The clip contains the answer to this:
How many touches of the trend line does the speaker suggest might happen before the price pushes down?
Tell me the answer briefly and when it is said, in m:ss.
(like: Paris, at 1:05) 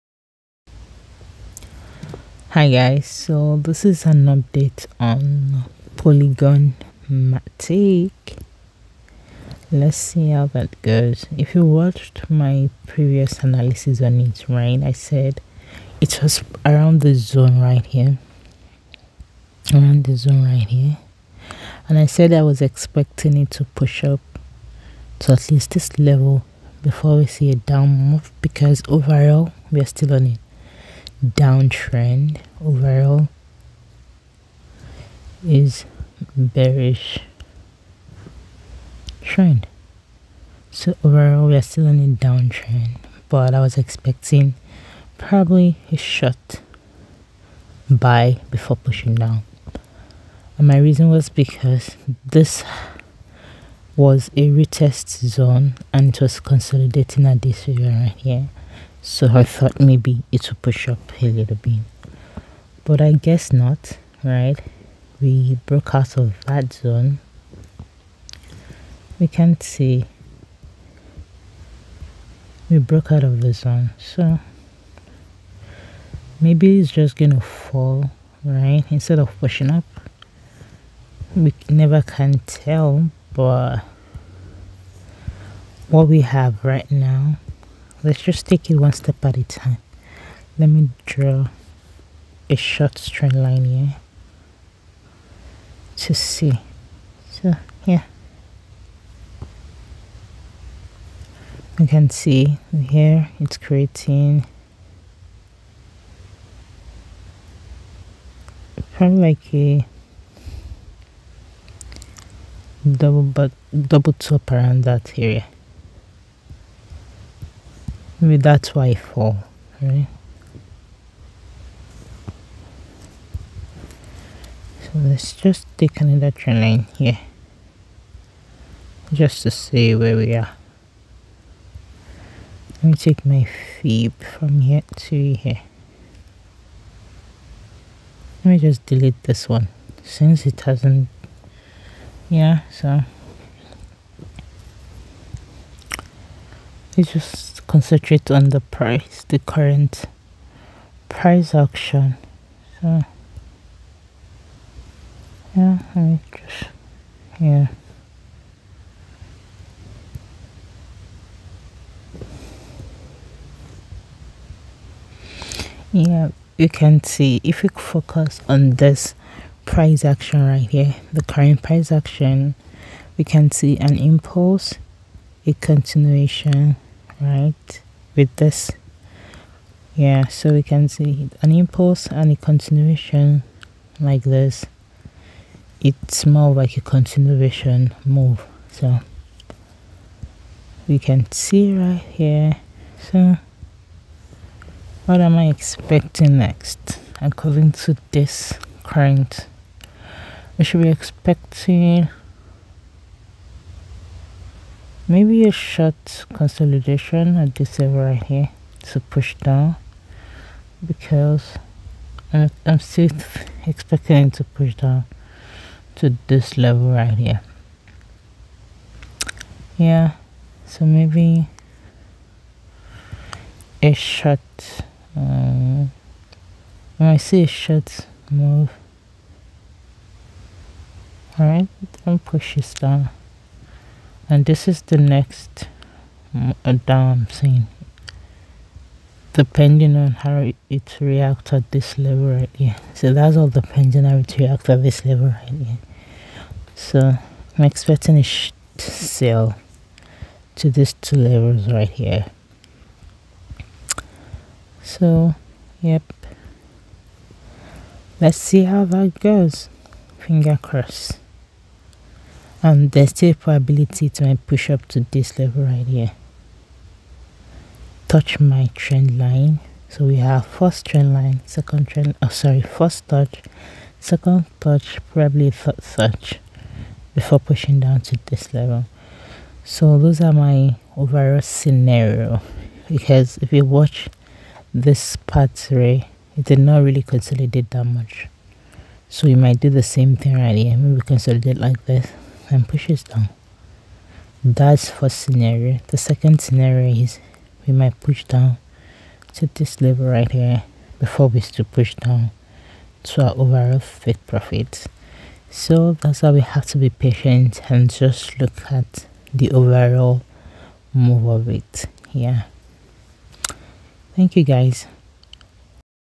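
3, at 4:35.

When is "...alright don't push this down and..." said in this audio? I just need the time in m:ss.
3:51.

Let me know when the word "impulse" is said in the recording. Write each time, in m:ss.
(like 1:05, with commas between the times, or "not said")
2:53, 3:01.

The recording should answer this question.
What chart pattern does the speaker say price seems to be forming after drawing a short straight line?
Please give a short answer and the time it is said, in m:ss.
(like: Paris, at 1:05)
double top, at 1:53.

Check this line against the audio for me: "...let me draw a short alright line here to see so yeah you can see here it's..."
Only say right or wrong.
wrong.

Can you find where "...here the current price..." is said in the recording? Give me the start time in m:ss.
2:50.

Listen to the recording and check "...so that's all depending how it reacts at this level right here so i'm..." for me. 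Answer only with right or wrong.
right.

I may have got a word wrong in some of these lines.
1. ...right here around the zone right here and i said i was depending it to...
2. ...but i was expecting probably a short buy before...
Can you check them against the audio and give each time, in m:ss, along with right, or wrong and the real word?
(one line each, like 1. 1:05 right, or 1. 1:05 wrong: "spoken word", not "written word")
1. 0:17 wrong: "expecting", not "depending"
2. 0:43 right.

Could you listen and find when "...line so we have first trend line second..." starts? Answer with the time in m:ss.
4:29.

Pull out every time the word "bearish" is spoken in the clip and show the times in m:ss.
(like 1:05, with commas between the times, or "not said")
0:36.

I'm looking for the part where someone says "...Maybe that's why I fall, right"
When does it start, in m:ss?
1:58.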